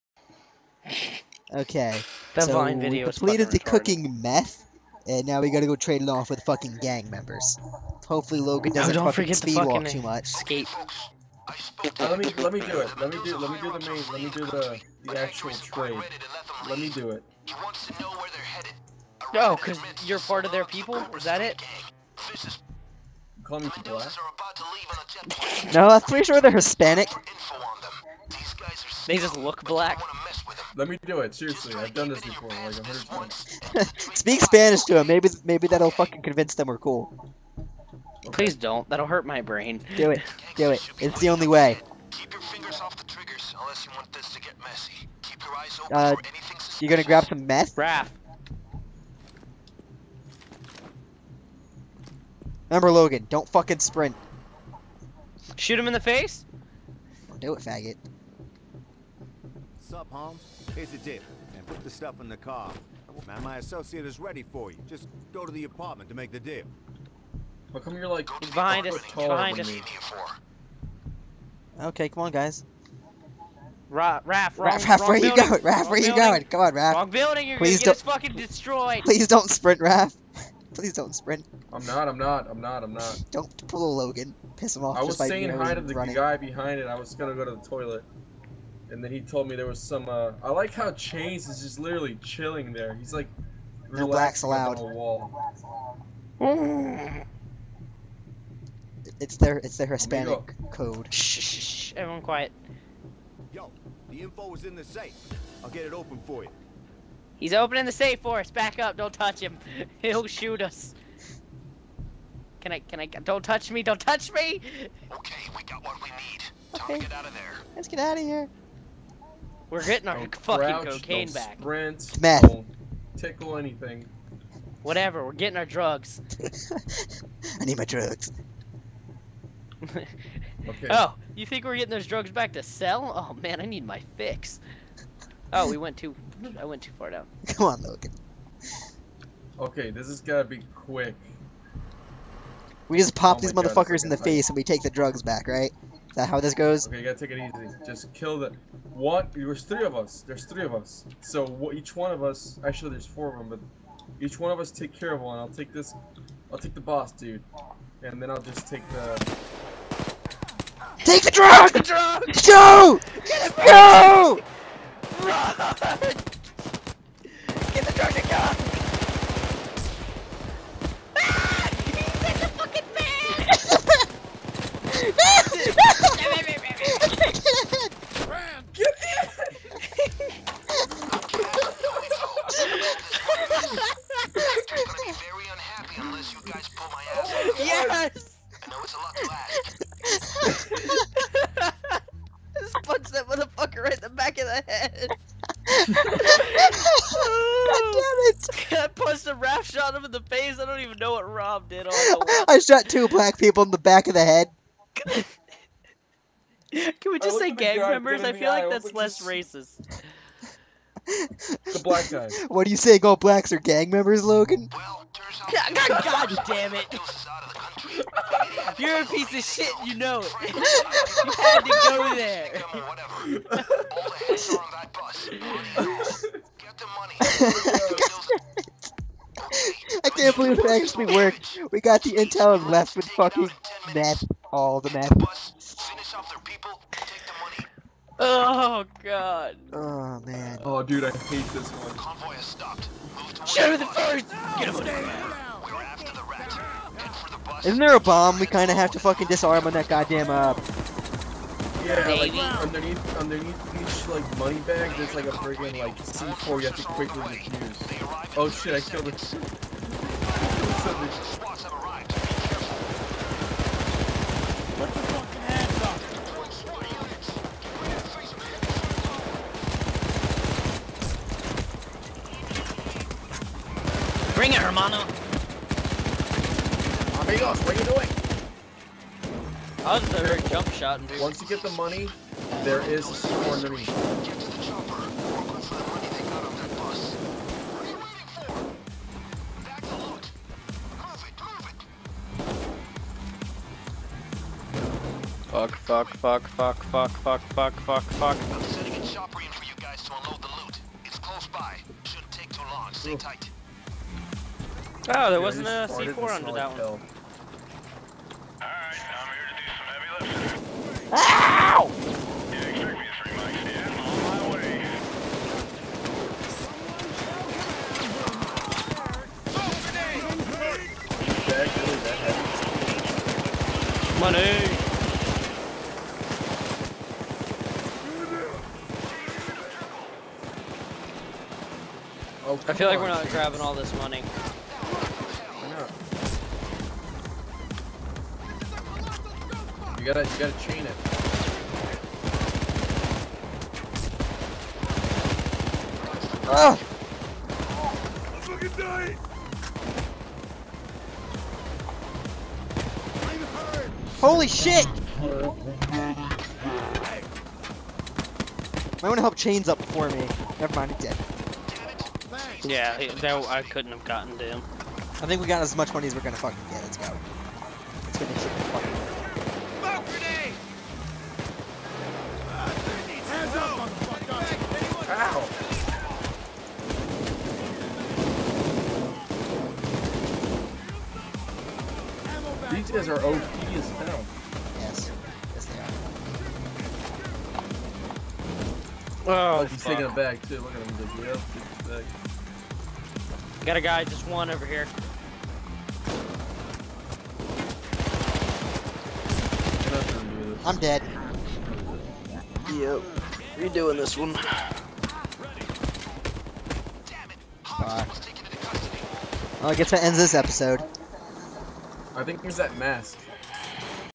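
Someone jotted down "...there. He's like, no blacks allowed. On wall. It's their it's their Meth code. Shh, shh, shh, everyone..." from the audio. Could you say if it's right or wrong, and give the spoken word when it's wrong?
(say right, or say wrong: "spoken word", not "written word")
wrong: "Hispanic", not "Meth".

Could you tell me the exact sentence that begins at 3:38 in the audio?
You're a piece of shit, you know it.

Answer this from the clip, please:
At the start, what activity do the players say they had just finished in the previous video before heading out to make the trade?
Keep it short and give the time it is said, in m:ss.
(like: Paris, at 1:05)
cooking meth, at 0:03.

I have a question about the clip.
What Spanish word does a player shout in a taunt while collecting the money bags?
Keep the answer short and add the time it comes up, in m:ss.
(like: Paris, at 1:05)
Hermano, at 4:34.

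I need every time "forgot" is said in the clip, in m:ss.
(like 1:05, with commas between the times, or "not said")
not said.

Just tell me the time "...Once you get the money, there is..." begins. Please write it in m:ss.
4:41.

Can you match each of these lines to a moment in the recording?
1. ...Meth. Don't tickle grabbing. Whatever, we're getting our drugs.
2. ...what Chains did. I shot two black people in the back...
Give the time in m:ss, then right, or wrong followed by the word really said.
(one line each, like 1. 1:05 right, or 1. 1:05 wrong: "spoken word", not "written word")
1. 2:02 wrong: "anything", not "grabbing"
2. 3:21 wrong: "Rob", not "Chains".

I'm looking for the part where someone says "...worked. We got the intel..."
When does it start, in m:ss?
3:51.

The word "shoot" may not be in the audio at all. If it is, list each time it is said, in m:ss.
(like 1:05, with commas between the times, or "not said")
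0:55, 1:50.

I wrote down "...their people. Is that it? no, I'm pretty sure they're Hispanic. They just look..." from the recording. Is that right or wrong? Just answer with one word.
right.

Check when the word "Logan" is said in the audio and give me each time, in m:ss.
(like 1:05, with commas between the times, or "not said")
0:08, 0:52, 1:24, 2:17, 3:34.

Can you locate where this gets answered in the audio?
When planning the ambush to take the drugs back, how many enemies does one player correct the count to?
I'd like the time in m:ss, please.
2:33.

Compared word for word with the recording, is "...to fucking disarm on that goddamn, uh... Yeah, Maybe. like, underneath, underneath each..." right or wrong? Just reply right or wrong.
right.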